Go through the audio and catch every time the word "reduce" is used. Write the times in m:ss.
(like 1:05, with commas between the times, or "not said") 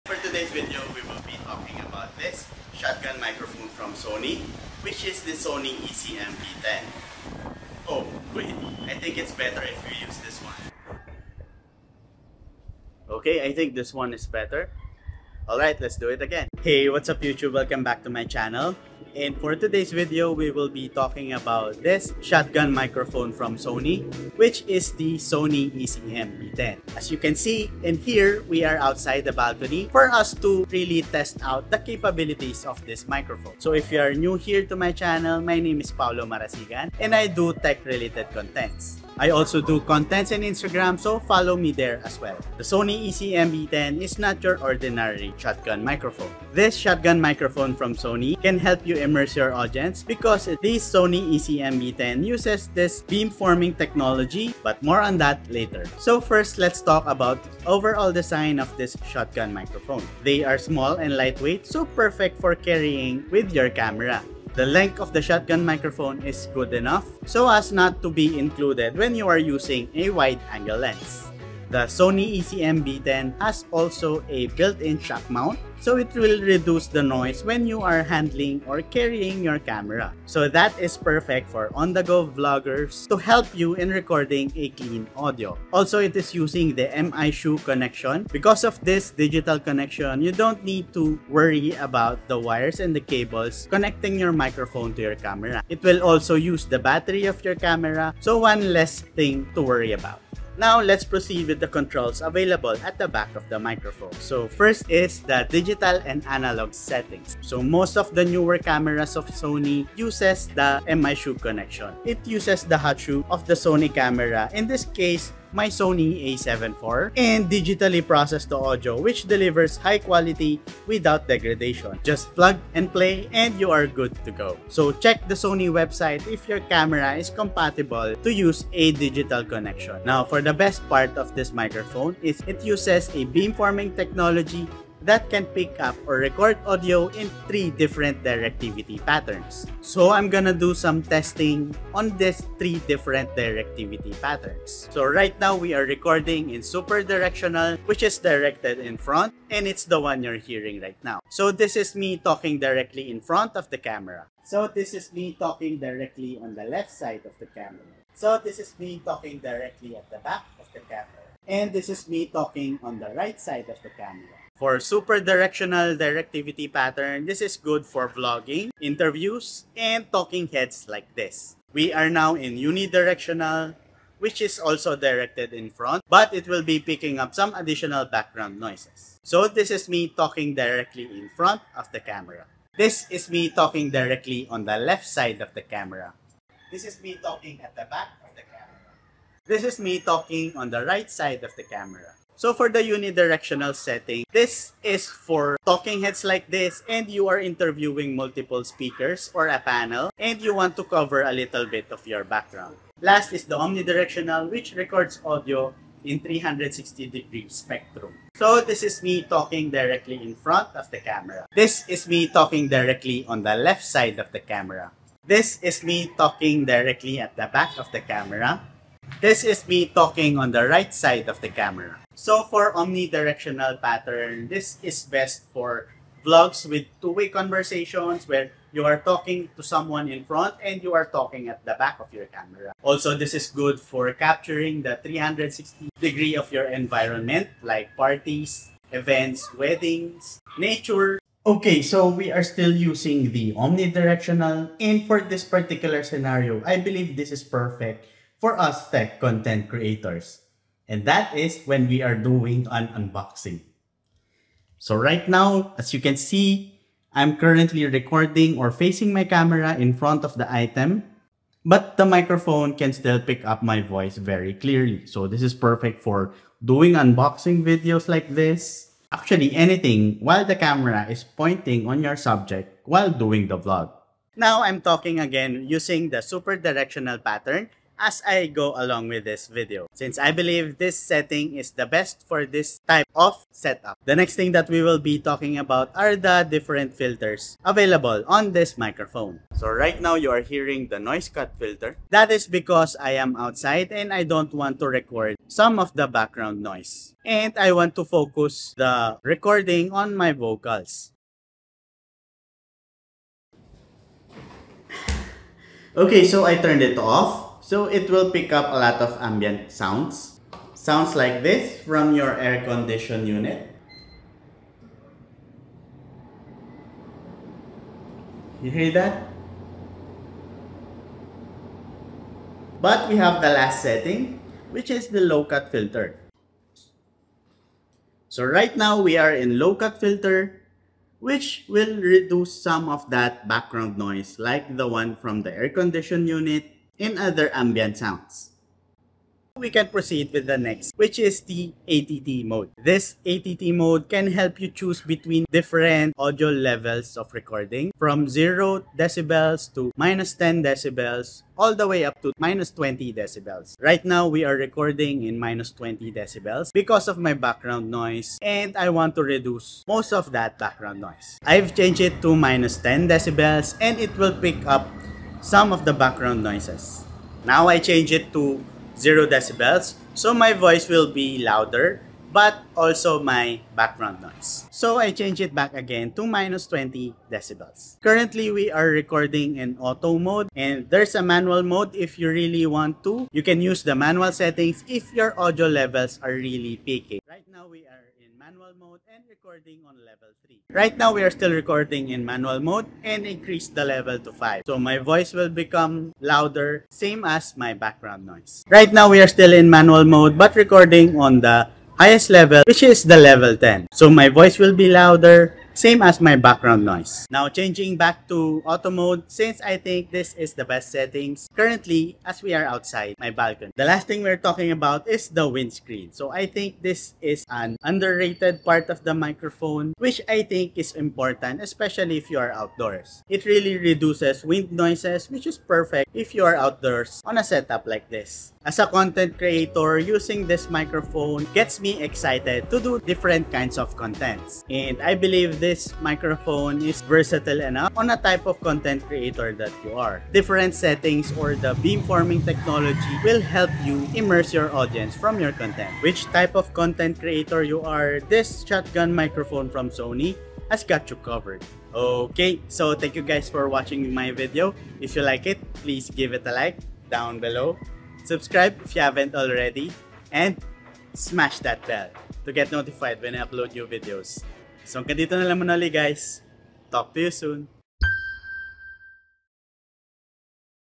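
1:16, 5:32, 5:59, 7:03.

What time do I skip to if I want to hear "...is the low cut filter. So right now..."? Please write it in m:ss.
5:24.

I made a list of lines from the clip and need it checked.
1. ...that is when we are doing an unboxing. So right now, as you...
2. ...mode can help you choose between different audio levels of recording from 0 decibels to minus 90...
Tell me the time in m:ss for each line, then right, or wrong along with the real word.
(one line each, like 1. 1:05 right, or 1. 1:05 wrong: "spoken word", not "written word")
1. 4:11 right
2. 5:43 wrong: "10", not "90".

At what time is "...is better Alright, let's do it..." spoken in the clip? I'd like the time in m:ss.
0:14.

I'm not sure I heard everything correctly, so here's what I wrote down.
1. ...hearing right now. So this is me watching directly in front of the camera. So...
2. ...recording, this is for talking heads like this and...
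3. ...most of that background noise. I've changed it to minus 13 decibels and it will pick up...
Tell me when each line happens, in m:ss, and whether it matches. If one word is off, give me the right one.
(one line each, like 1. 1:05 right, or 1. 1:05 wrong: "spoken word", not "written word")
1. 2:30 wrong: "talking", not "watching"
2. 3:13 wrong: "setting", not "recording"
3. 5:59 wrong: "10", not "13".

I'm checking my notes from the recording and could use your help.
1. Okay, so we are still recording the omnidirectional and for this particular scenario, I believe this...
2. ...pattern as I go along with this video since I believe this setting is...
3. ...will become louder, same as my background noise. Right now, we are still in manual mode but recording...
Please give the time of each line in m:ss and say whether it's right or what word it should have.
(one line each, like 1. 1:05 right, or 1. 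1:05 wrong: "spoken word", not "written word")
1. 4:01 wrong: "using", not "recording"
2. 4:37 right
3. 6:35 right.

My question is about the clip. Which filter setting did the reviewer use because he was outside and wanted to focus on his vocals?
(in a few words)
noise cut filter.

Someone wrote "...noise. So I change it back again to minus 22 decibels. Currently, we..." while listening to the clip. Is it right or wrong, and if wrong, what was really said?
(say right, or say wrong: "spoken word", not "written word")
wrong: "20", not "22".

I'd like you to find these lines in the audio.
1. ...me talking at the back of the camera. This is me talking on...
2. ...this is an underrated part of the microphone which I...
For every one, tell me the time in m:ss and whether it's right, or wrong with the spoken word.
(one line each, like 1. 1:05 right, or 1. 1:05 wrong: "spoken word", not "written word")
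1. 3:07 right
2. 6:56 right.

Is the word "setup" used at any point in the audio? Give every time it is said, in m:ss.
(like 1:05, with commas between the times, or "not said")
4:43, 7:07.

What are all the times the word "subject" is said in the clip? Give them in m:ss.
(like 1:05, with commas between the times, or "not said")
4:32.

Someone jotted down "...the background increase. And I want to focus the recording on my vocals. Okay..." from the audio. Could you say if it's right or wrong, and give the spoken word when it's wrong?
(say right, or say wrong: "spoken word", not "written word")
wrong: "noise", not "increase".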